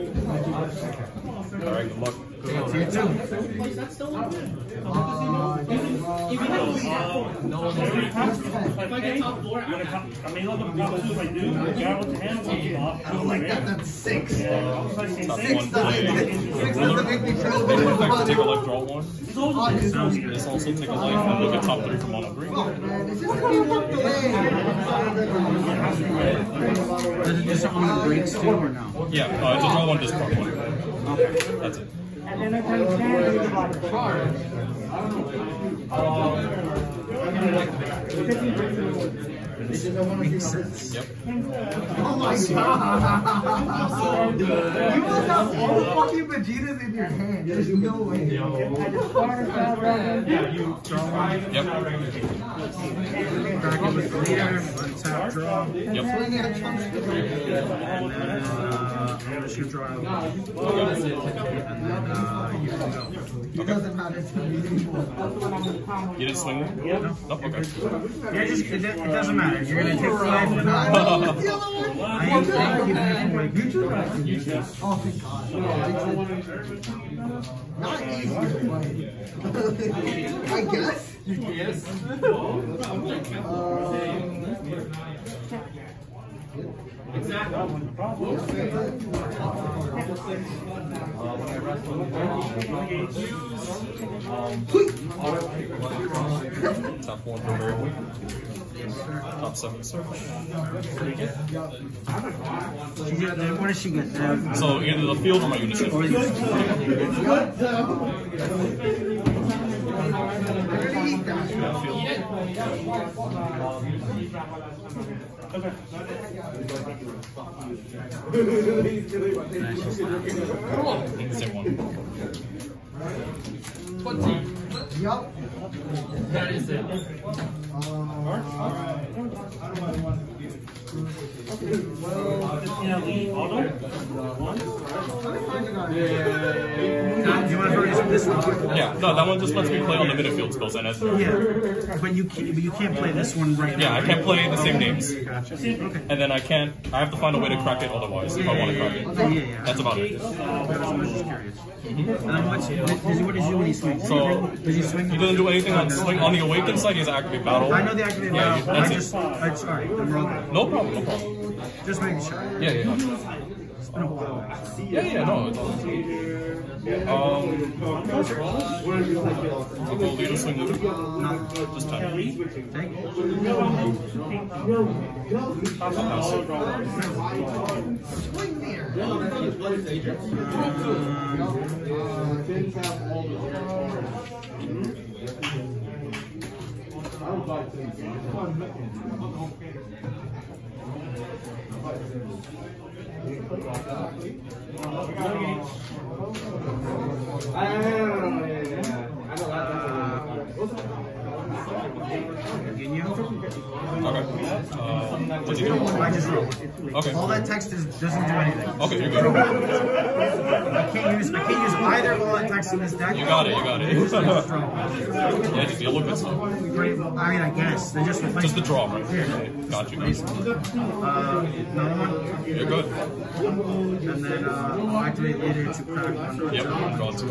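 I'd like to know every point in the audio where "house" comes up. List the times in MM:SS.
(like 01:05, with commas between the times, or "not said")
02:56.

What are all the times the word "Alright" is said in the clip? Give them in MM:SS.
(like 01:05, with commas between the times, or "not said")
00:01.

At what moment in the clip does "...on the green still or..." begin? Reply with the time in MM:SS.
00:27.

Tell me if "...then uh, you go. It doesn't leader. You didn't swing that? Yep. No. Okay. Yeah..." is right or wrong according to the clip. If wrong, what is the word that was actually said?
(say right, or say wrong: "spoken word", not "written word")
wrong: "matter", not "leader".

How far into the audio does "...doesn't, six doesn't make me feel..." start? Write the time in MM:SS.
00:14.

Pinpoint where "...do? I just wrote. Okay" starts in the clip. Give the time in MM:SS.
03:25.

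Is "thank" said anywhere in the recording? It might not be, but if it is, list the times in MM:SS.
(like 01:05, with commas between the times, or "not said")
01:14, 02:52.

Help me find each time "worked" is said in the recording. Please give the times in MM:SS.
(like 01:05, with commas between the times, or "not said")
00:23.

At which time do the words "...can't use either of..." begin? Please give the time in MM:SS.
03:31.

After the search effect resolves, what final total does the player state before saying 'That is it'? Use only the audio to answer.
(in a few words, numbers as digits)
20.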